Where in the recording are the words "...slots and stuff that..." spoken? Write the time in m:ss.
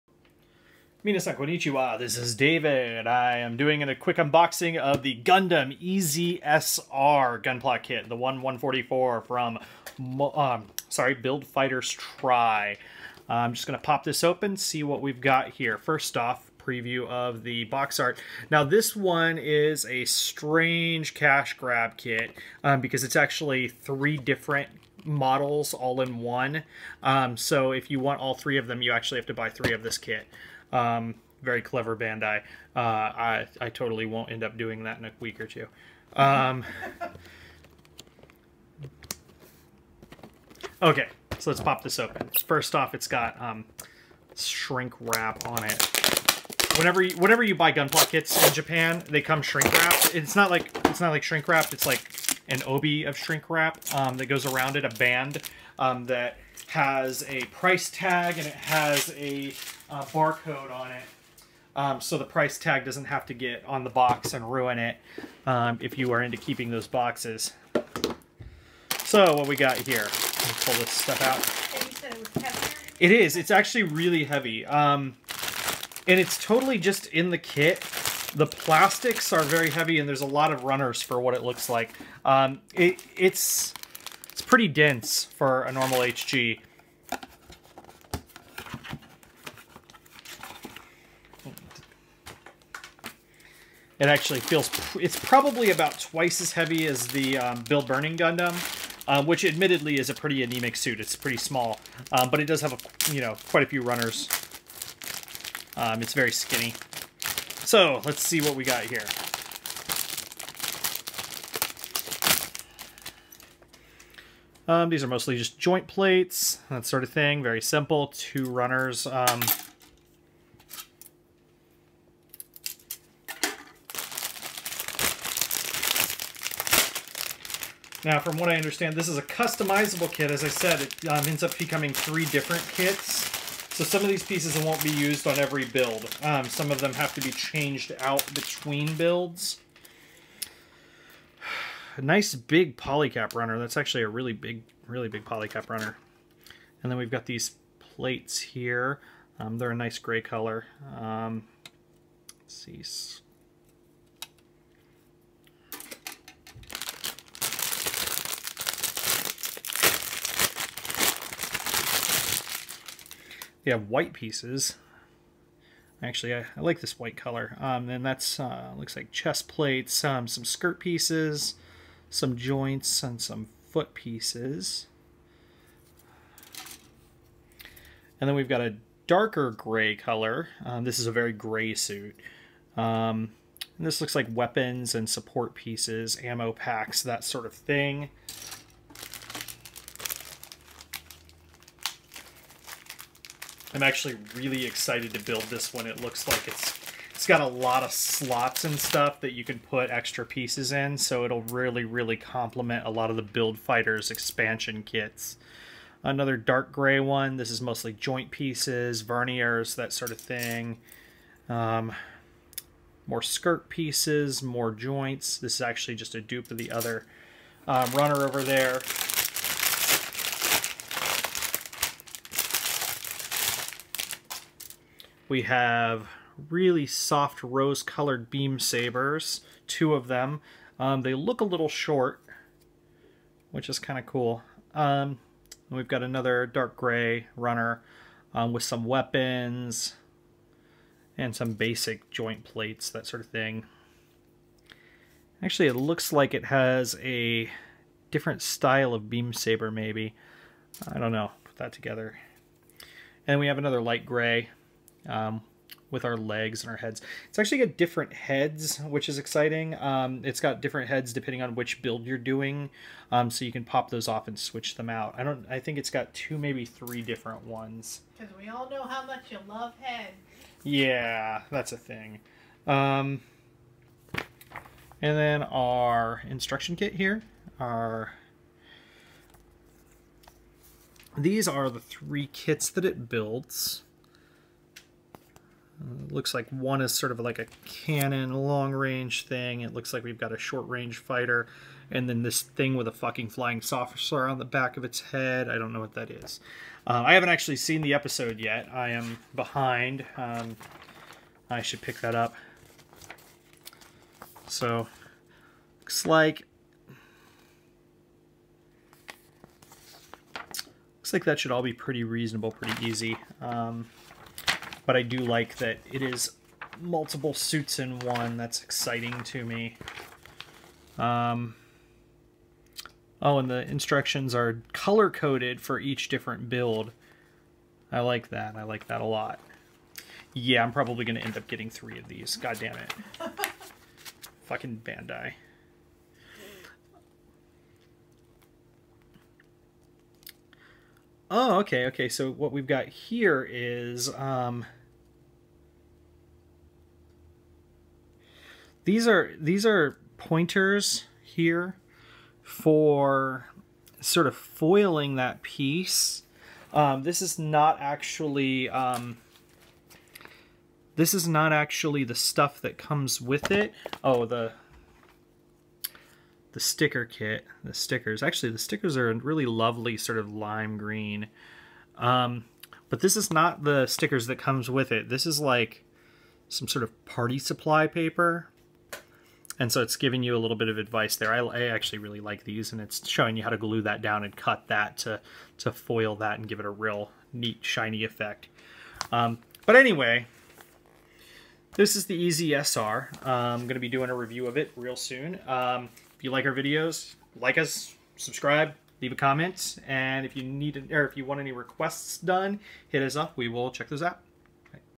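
3:17.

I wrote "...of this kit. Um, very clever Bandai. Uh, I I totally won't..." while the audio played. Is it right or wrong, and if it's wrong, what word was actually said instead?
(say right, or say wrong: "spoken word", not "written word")
right.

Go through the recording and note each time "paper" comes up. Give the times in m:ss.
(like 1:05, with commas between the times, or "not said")
6:17.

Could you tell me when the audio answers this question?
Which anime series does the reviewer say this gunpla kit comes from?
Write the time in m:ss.
0:11.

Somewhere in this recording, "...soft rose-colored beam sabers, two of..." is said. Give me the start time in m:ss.
3:46.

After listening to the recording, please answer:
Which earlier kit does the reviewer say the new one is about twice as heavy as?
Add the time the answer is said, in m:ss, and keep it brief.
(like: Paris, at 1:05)
Build Burning Gundam, at 1:37.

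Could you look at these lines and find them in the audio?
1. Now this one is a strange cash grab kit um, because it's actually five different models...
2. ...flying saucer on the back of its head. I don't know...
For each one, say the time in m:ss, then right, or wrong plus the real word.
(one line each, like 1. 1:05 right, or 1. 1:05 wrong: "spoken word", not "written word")
1. 0:18 wrong: "three", not "five"
2. 4:53 right.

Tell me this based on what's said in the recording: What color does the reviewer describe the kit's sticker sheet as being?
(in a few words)
Lime green.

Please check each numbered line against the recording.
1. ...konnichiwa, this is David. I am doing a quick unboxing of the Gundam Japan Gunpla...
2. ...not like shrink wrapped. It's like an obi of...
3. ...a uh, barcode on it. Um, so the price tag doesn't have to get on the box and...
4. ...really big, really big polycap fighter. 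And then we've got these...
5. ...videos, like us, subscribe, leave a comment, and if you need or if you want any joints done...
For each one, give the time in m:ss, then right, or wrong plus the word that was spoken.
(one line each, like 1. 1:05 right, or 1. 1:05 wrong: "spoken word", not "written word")
1. 0:01 wrong: "EZSR", not "Japan"
2. 0:51 right
3. 0:59 right
4. 2:24 wrong: "runner", not "fighter"
5. 6:36 wrong: "requests", not "joints".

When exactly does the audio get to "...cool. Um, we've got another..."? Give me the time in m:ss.
3:54.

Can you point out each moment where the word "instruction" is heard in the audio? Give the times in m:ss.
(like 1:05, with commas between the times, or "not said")
4:36, 5:23.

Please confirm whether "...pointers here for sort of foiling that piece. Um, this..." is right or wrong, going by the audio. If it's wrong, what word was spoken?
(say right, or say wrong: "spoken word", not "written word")
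right.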